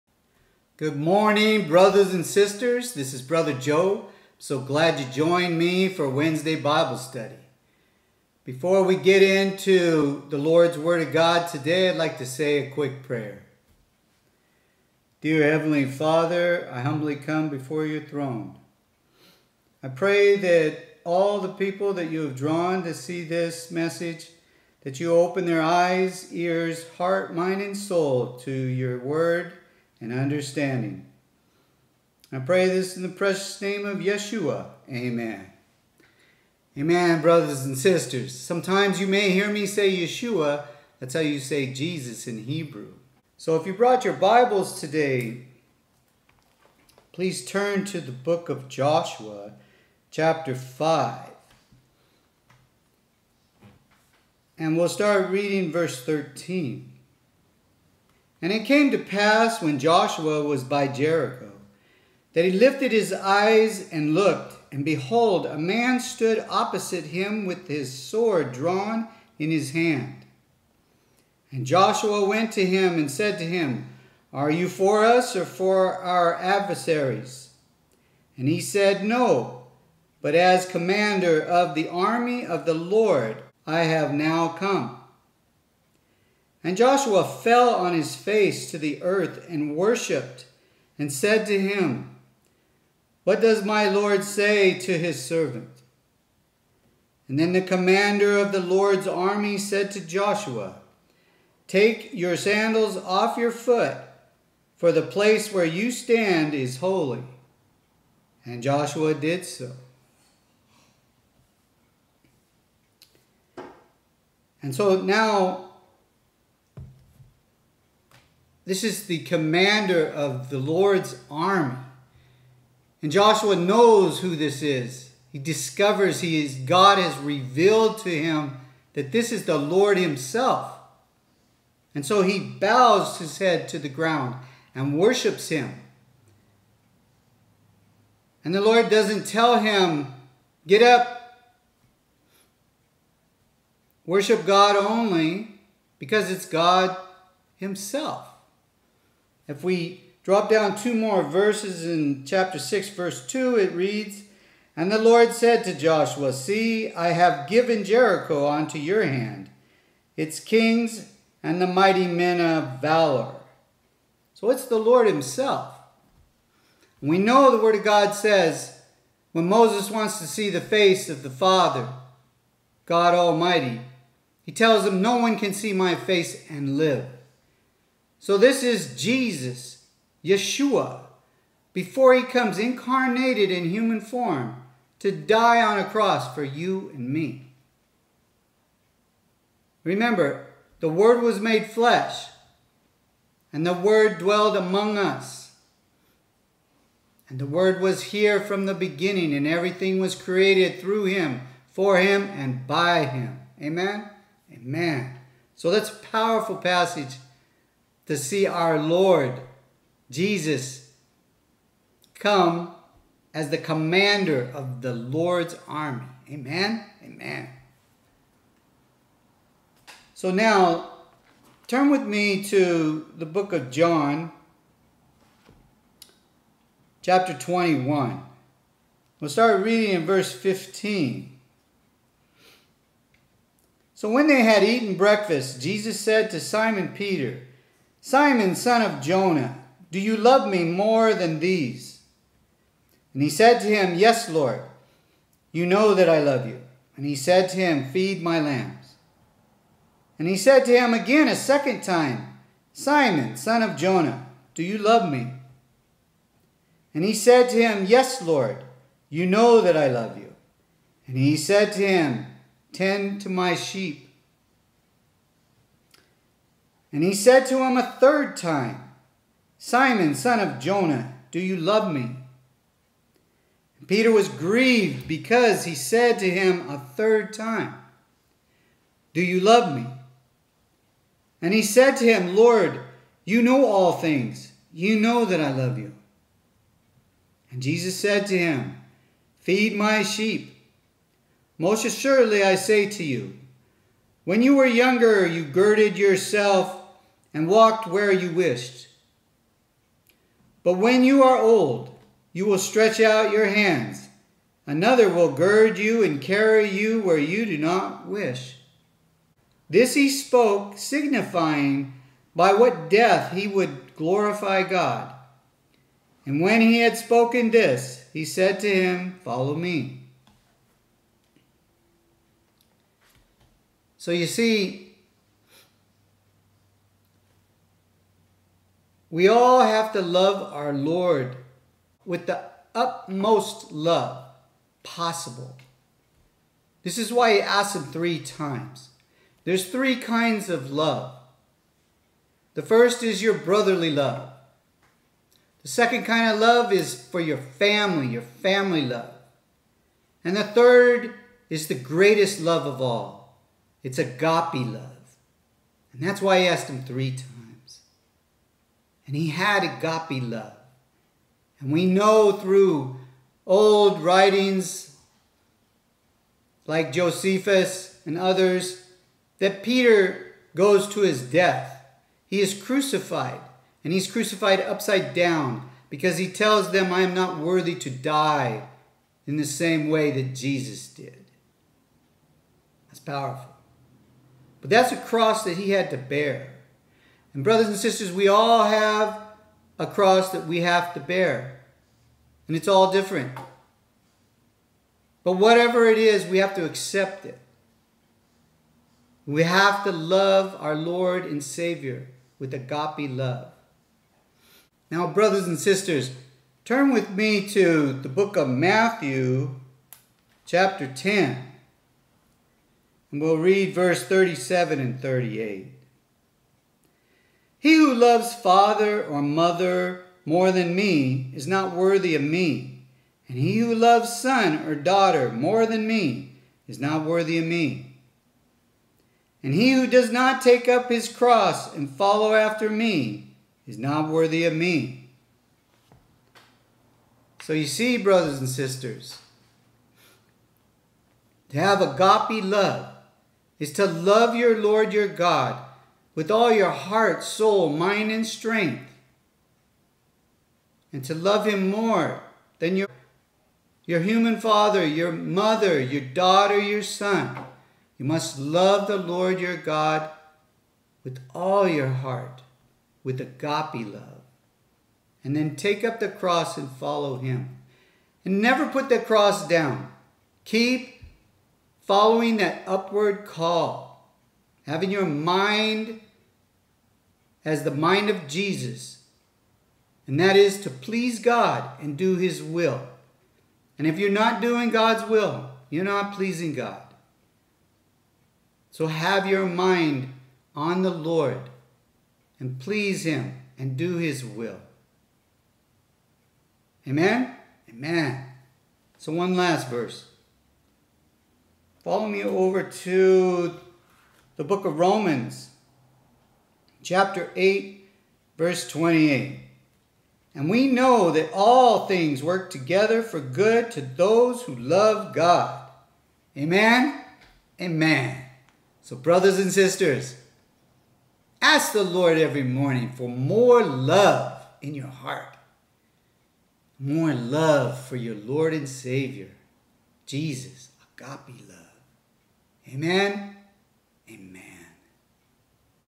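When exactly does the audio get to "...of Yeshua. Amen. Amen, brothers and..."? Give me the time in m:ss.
0:33.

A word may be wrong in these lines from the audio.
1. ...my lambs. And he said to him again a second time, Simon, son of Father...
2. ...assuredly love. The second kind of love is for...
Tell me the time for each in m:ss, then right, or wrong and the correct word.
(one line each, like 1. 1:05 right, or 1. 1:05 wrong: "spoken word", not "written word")
1. 4:08 wrong: "Jonah", not "Father"
2. 5:43 wrong: "brotherly", not "assuredly".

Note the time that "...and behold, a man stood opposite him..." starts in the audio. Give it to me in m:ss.
1:04.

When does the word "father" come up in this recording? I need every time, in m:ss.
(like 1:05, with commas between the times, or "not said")
0:15, 2:51, 6:58, 7:34.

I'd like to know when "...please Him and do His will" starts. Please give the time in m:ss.
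8:12.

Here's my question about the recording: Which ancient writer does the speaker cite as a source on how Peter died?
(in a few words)
Josephus.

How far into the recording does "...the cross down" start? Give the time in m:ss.
7:48.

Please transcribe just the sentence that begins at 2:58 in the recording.
So this is Jesus, Yeshua, before he comes incarnated in human form to die on a cross for you and me.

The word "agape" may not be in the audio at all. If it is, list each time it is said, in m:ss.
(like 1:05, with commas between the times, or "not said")
5:53, 5:59, 6:42, 7:21, 7:43, 8:50.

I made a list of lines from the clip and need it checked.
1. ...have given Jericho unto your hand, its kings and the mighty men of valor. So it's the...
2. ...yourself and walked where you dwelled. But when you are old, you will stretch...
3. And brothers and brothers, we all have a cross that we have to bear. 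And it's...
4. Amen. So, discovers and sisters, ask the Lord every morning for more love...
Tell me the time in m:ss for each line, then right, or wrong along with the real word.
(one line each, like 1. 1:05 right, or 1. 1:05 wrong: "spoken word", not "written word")
1. 2:37 right
2. 4:55 wrong: "wished", not "dwelled"
3. 6:27 wrong: "sisters", not "brothers"
4. 8:37 wrong: "brothers", not "discovers".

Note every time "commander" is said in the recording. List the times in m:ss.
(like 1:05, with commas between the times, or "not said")
1:20, 1:37, 1:59, 3:33.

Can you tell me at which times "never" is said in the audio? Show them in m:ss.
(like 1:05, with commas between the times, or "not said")
7:48.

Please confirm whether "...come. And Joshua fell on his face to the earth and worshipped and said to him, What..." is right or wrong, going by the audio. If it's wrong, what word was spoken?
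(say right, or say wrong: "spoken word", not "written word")
right.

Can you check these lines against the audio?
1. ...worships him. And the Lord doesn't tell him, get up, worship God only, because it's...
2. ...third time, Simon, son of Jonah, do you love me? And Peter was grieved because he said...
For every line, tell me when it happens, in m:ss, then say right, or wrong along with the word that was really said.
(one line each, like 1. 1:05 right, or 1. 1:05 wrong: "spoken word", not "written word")
1. 2:14 right
2. 4:27 right.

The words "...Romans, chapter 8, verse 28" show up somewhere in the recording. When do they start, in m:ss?
8:24.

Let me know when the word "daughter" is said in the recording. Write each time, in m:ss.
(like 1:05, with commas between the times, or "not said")
7:04, 7:36.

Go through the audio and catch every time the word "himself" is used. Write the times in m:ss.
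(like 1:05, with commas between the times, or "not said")
2:09, 2:27, 2:45.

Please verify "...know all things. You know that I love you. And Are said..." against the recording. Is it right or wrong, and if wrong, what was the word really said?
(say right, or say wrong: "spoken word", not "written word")
wrong: "Jesus", not "Are".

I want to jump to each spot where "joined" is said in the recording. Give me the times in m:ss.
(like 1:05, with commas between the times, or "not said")
0:05.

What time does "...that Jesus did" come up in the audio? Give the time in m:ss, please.
6:20.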